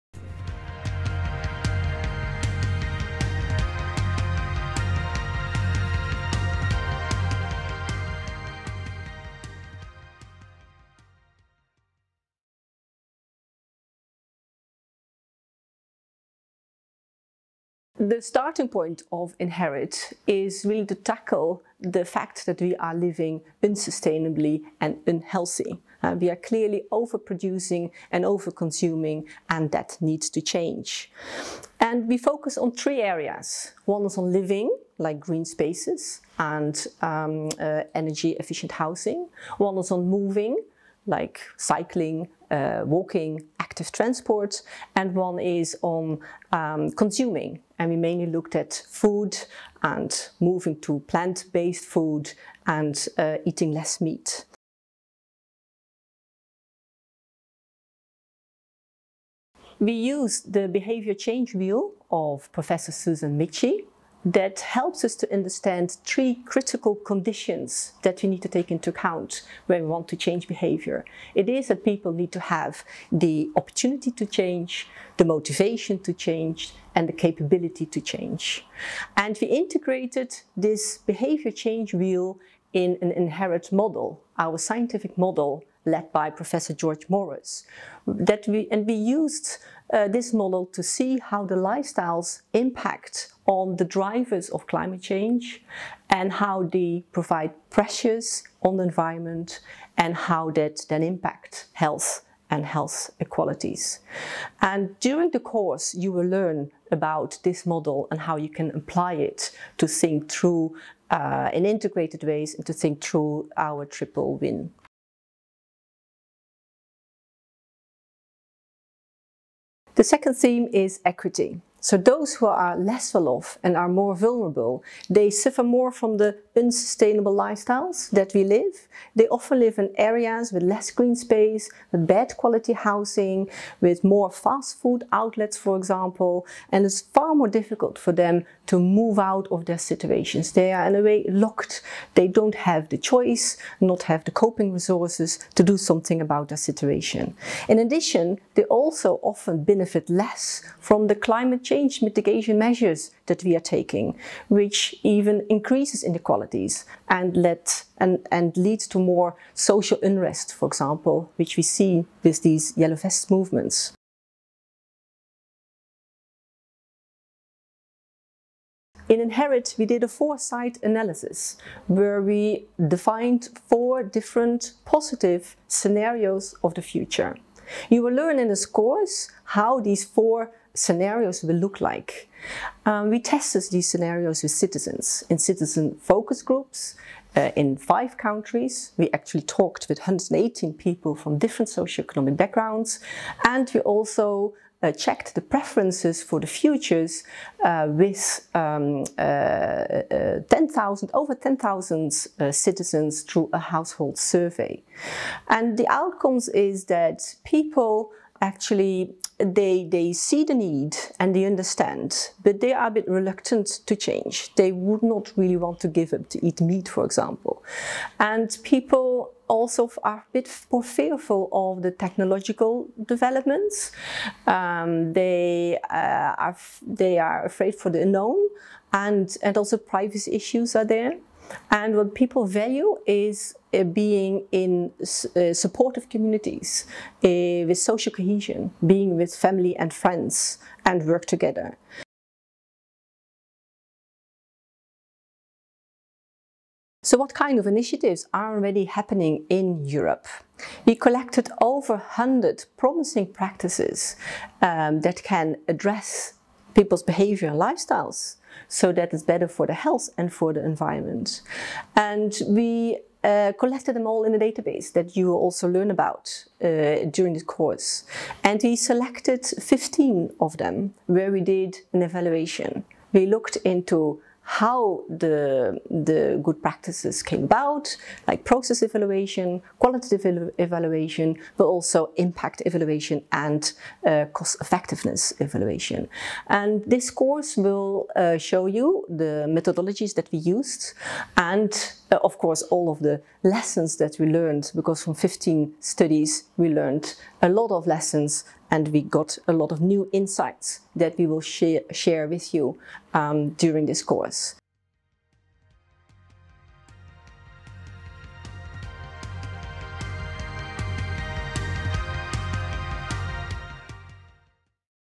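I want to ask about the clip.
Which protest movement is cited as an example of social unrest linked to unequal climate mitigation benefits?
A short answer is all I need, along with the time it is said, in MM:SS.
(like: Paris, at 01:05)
yellow vest movements, at 02:42.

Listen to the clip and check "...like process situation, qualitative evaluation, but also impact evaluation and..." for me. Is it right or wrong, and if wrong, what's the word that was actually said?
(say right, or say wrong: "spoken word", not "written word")
wrong: "evaluation", not "situation".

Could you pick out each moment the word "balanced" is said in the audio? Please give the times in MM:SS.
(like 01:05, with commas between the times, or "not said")
not said.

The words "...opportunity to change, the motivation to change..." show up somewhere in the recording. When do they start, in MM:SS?
01:13.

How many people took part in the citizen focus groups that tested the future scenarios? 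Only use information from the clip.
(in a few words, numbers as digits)
118.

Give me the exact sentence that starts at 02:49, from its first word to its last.
In Inherit, we did a foresight analysis where we defined four different positive scenarios of the future.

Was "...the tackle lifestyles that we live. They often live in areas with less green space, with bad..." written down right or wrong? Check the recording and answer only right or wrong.
wrong.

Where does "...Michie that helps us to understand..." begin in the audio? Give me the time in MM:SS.
01:03.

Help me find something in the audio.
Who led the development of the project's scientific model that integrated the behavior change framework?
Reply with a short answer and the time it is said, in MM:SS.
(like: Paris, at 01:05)
George Morris, at 01:26.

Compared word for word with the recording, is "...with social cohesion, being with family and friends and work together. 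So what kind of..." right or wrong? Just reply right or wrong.
right.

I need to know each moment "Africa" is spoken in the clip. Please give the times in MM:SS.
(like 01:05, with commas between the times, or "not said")
not said.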